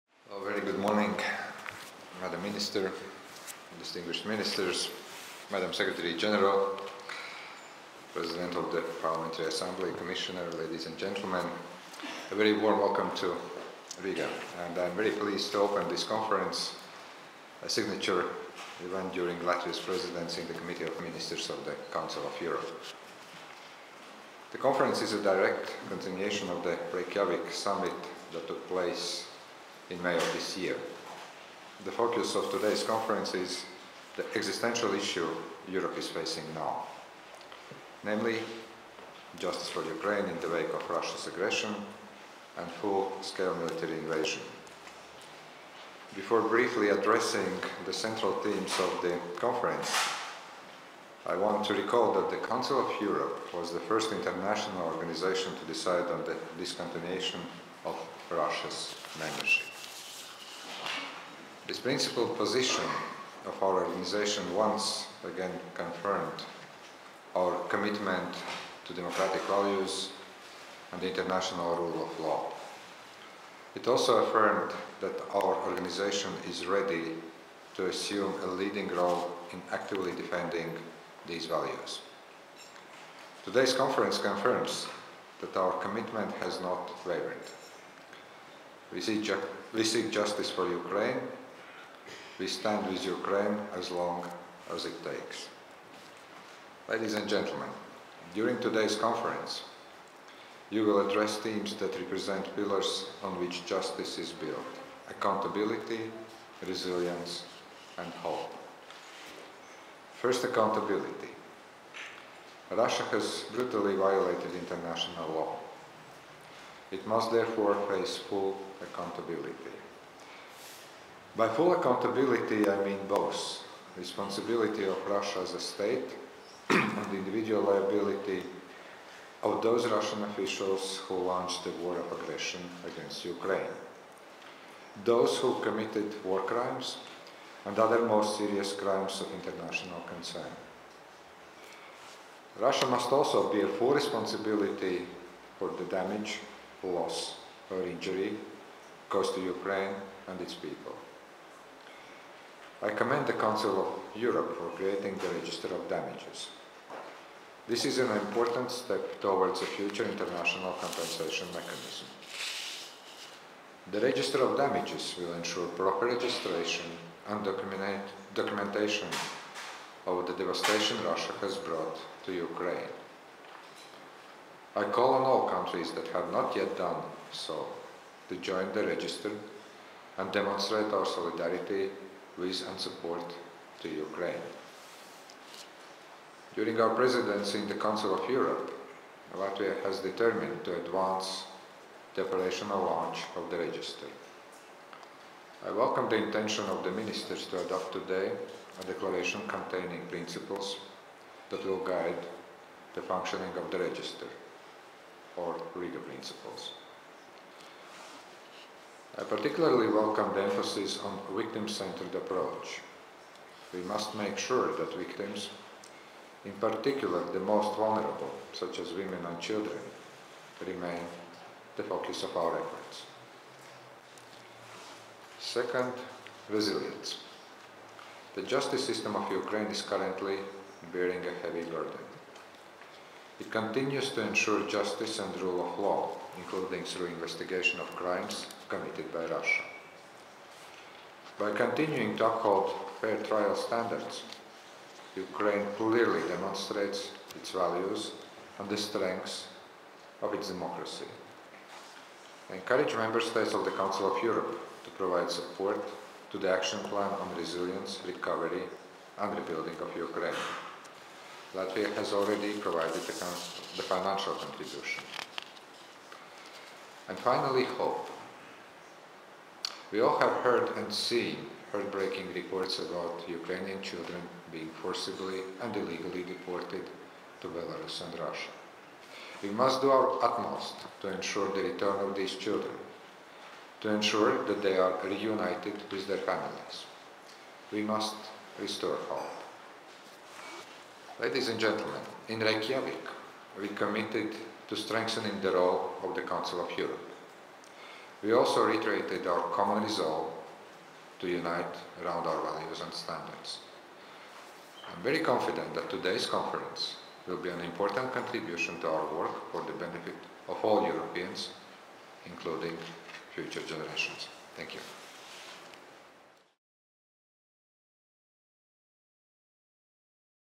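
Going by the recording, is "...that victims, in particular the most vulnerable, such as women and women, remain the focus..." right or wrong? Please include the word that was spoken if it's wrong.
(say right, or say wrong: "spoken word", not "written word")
wrong: "children", not "women".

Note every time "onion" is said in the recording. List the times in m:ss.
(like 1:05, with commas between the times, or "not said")
not said.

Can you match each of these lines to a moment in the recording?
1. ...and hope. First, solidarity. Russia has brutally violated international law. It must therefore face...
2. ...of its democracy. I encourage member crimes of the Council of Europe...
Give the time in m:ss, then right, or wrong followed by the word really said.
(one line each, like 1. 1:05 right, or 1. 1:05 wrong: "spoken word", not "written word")
1. 1:47 wrong: "accountability", not "solidarity"
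2. 4:10 wrong: "states", not "crimes".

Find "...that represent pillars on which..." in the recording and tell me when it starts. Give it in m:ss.
1:41.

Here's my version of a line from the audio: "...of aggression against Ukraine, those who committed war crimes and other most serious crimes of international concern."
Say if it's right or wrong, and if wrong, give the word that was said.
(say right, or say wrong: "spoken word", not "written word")
right.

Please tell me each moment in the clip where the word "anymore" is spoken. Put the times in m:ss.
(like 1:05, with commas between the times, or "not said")
not said.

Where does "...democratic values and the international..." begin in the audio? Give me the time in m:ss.
1:08.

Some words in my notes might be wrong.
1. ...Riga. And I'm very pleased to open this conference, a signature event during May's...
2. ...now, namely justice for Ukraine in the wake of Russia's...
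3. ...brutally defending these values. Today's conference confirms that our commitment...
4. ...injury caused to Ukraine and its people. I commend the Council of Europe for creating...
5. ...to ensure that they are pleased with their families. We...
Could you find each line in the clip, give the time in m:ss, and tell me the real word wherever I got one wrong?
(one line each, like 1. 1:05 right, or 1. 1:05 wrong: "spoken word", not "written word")
1. 0:14 wrong: "Latvia", not "May"
2. 0:36 right
3. 1:19 wrong: "actively", not "brutally"
4. 2:27 right
5. 4:43 wrong: "reunited", not "pleased".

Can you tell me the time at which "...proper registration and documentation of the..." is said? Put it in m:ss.
2:45.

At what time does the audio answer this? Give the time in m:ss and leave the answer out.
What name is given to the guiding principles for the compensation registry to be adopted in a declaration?
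3:25.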